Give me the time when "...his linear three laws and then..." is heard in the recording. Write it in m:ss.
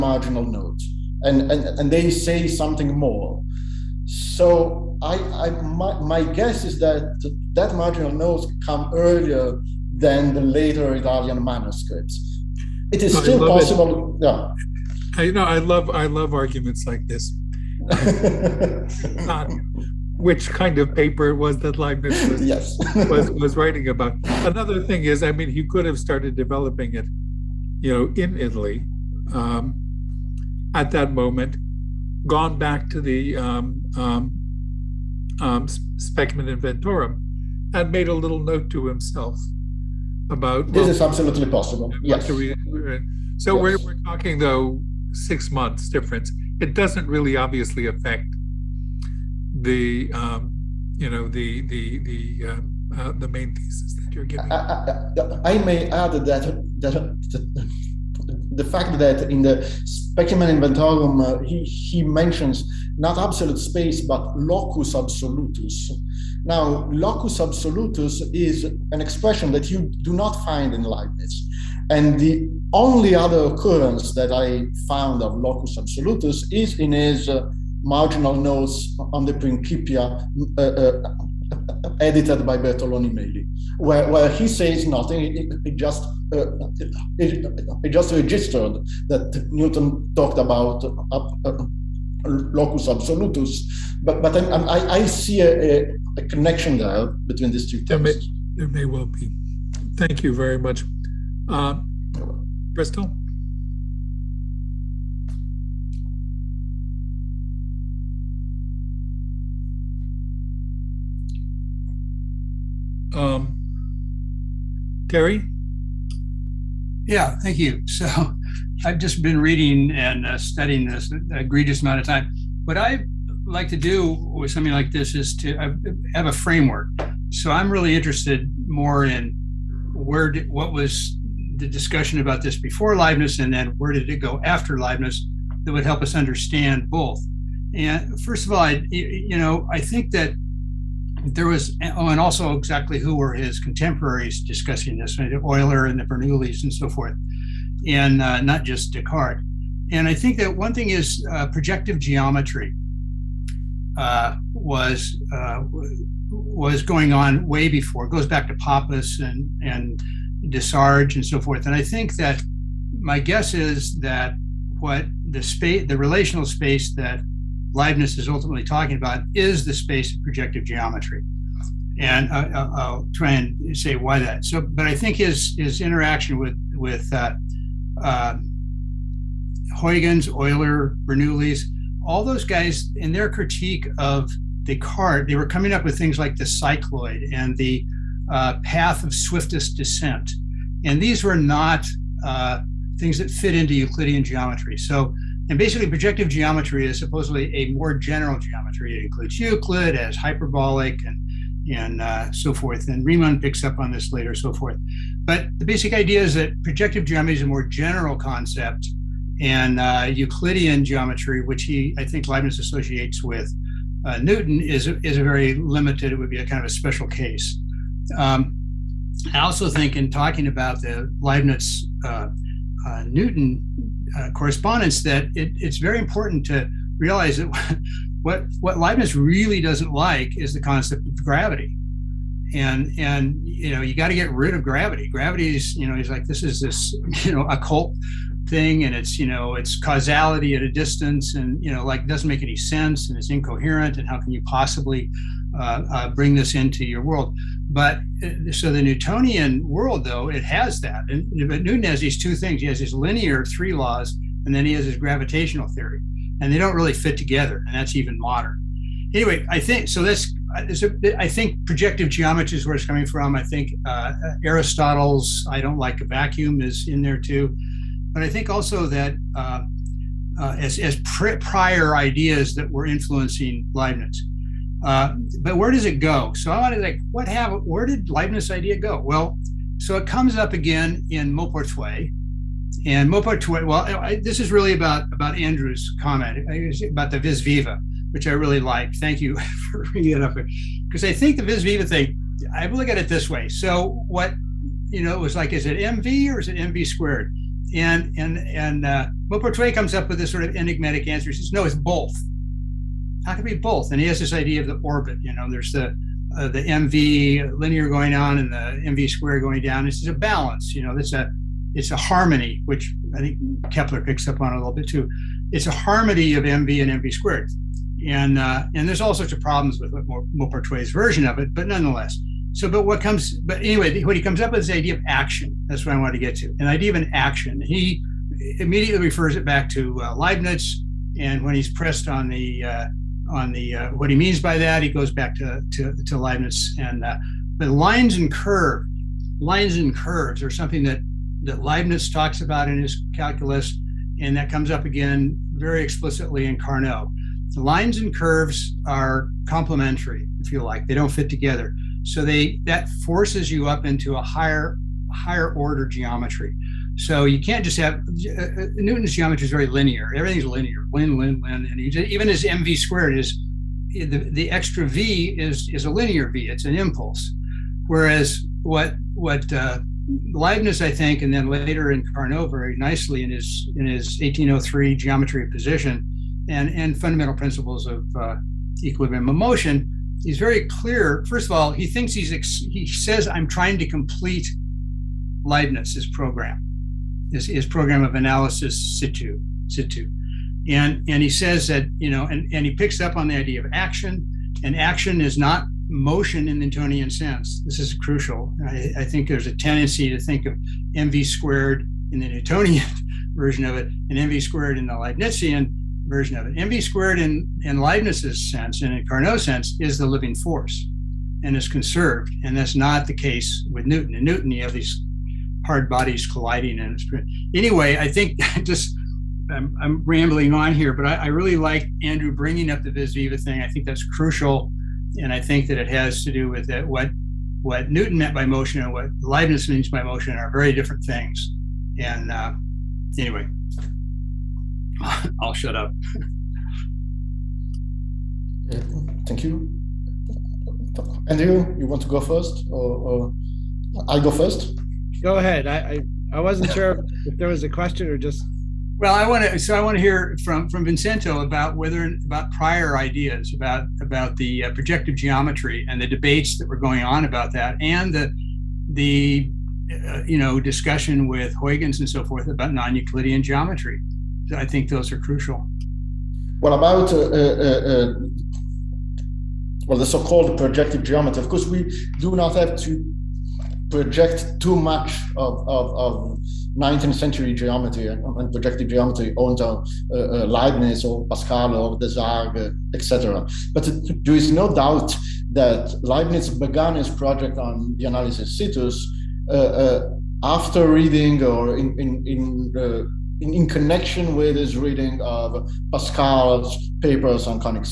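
4:12.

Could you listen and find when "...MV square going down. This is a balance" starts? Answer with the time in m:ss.
5:08.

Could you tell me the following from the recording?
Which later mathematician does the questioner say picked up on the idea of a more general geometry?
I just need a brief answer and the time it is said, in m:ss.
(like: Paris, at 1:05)
Riemann, at 3:23.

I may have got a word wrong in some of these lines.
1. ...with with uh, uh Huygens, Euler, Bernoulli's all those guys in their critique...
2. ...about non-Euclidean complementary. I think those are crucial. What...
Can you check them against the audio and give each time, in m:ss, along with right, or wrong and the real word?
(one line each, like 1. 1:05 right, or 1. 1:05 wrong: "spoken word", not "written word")
1. 2:56 right
2. 7:42 wrong: "geometry", not "complementary".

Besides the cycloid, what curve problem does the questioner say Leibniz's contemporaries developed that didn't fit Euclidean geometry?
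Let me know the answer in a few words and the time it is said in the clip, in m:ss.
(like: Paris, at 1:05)
path of swiftest descent, at 3:08.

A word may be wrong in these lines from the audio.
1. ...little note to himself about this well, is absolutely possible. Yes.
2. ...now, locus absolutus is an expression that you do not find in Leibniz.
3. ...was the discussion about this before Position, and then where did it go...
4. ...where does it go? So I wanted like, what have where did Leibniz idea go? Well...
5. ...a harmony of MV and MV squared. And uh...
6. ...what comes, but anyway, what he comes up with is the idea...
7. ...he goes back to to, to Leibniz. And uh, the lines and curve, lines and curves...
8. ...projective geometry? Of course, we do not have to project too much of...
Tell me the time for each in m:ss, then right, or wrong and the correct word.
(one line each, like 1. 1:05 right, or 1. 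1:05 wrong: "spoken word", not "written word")
1. 0:38 right
2. 1:06 right
3. 2:10 wrong: "Leibniz", not "Position"
4. 4:35 right
5. 5:15 right
6. 5:22 right
7. 5:34 right
8. 7:50 right.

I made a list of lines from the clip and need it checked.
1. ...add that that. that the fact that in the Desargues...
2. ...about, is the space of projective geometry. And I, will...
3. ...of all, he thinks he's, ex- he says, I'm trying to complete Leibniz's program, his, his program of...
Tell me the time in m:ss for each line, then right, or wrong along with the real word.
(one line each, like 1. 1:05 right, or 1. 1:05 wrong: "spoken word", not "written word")
1. 0:55 wrong: "Specimen", not "Desargues"
2. 2:48 right
3. 6:21 right.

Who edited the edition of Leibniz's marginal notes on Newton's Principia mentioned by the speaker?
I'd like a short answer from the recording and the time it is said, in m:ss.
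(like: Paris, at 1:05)
Bertoloni Meli, at 1:22.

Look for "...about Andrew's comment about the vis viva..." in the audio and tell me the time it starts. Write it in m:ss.
4:45.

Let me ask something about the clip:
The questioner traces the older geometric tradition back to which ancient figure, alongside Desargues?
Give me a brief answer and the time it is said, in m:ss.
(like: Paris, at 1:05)
Pappus, at 2:38.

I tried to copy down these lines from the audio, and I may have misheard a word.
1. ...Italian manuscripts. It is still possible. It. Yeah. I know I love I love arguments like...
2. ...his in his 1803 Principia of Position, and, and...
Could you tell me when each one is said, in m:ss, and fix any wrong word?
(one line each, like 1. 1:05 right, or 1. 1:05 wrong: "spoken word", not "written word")
1. 0:10 right
2. 6:13 wrong: "Geometry", not "Principia".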